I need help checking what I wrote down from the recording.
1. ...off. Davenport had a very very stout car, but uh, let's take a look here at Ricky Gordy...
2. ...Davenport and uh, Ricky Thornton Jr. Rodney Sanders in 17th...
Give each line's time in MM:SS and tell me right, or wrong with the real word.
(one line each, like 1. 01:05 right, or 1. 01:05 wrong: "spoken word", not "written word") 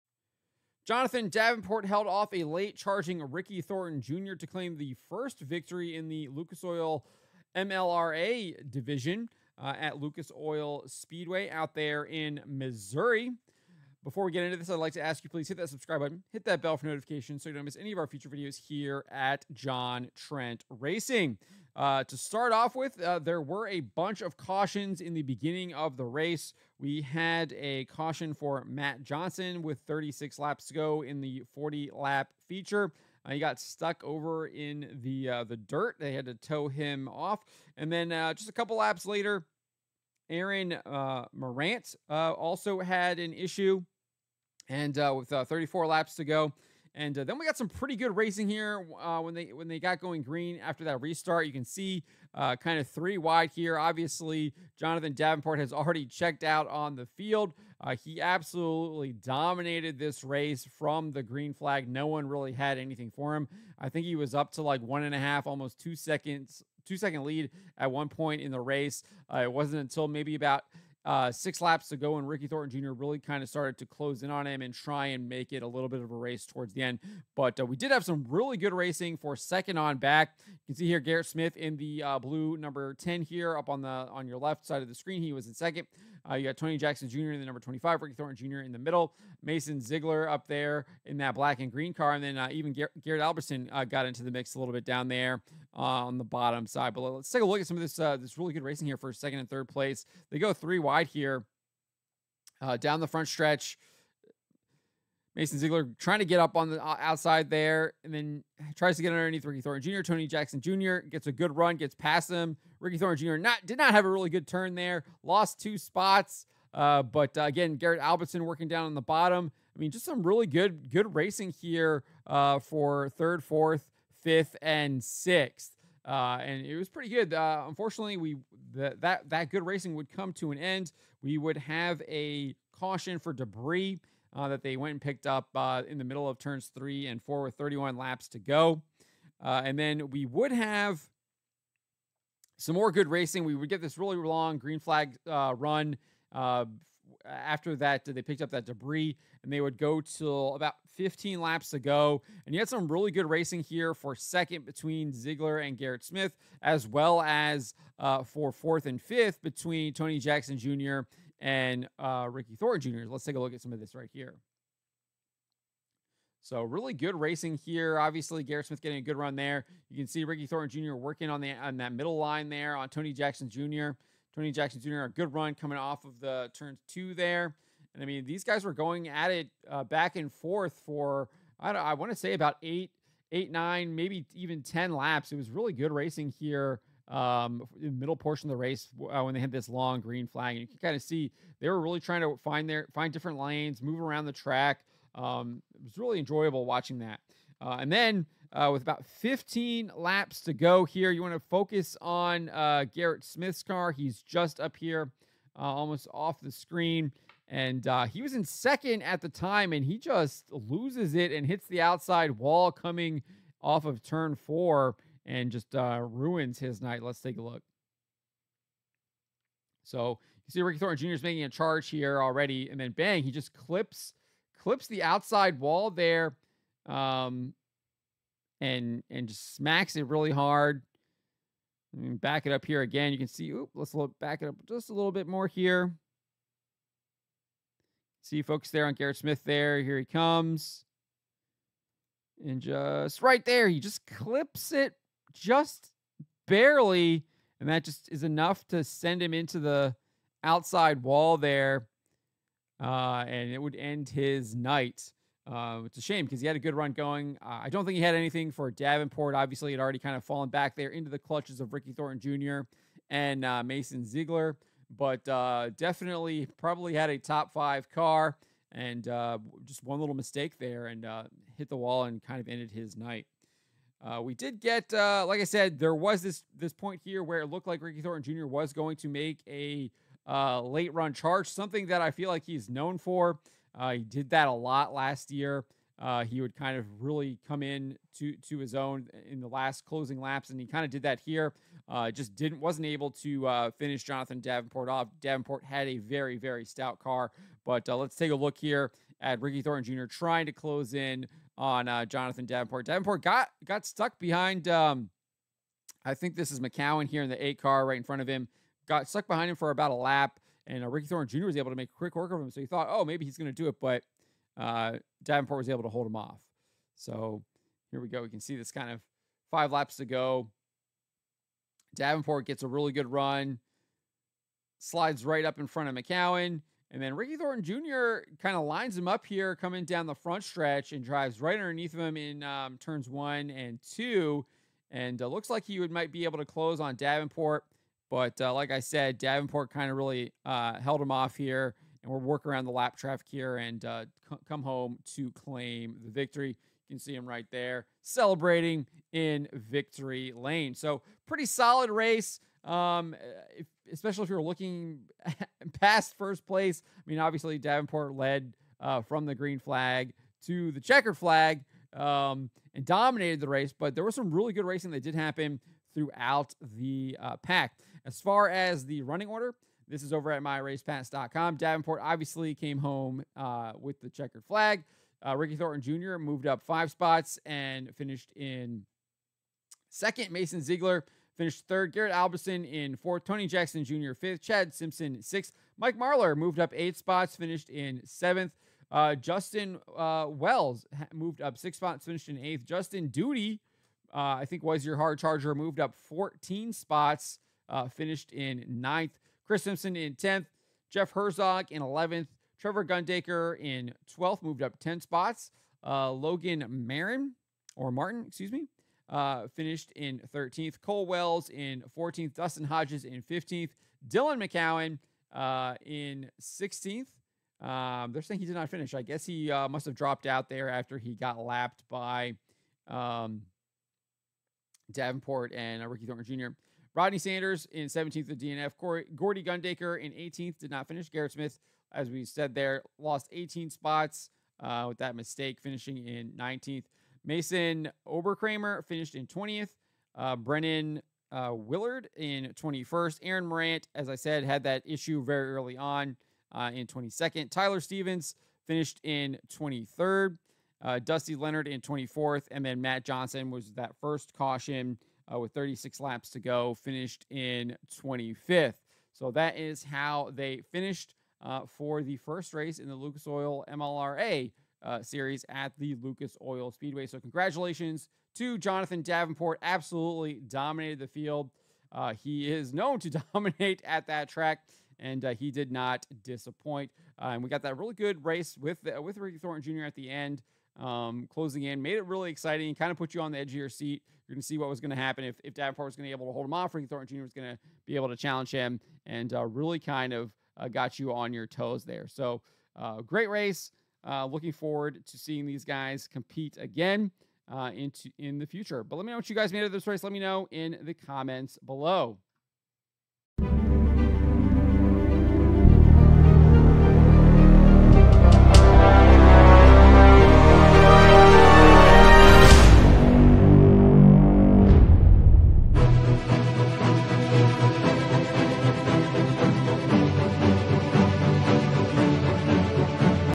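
1. 04:54 wrong: "Thornton", not "Gordy"
2. 07:04 right.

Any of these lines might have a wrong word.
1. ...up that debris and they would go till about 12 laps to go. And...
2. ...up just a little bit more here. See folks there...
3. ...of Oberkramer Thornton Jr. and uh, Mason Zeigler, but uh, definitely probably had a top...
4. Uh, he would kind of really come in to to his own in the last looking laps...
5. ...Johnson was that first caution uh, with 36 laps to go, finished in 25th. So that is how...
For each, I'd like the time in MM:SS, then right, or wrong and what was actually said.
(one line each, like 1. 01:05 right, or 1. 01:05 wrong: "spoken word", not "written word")
1. 02:28 wrong: "15", not "12"
2. 03:54 right
3. 04:21 wrong: "Ricky", not "Oberkramer"
4. 04:45 wrong: "closing", not "looking"
5. 07:33 right.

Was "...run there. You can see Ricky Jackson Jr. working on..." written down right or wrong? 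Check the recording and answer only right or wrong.
wrong.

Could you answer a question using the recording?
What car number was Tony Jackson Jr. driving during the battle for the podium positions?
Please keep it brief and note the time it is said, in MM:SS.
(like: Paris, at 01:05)
25, at 01:27.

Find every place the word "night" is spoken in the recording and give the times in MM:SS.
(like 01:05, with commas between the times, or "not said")
03:36, 04:14, 04:32.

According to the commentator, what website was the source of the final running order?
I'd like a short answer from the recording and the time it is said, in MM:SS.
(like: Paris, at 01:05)
myracepass.com, at 06:10.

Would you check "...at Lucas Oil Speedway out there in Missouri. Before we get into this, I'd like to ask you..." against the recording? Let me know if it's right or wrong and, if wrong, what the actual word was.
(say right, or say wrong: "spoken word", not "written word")
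right.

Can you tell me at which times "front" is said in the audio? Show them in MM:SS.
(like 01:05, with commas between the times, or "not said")
01:43, 05:08, 05:25, 05:30.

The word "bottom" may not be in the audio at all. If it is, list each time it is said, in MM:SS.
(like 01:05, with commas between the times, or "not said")
01:36, 01:59.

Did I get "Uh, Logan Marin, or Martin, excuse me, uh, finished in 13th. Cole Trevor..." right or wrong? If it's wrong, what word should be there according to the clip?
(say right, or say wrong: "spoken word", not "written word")
wrong: "Wells", not "Trevor".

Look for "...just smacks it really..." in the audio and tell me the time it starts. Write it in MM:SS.
03:49.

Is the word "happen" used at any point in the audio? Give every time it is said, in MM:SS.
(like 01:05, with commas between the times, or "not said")
06:05, 08:04.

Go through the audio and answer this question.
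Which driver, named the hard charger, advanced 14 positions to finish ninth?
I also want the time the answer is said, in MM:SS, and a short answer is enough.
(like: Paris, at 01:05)
Justin Duty, at 06:32.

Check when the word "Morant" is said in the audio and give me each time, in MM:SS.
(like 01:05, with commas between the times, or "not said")
00:41, 07:23.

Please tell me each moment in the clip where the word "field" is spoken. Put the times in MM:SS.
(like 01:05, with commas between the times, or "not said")
00:57, 07:51.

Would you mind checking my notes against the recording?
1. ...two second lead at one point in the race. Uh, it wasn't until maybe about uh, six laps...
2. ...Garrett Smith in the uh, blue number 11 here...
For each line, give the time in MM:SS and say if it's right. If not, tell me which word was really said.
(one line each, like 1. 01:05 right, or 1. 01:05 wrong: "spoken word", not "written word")
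1. 01:06 right
2. 01:20 wrong: "10", not "11".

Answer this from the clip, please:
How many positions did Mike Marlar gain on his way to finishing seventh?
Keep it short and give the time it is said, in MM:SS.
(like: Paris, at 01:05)
8, at 06:26.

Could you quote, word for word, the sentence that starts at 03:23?
He's just up here, uh, almost off the screen.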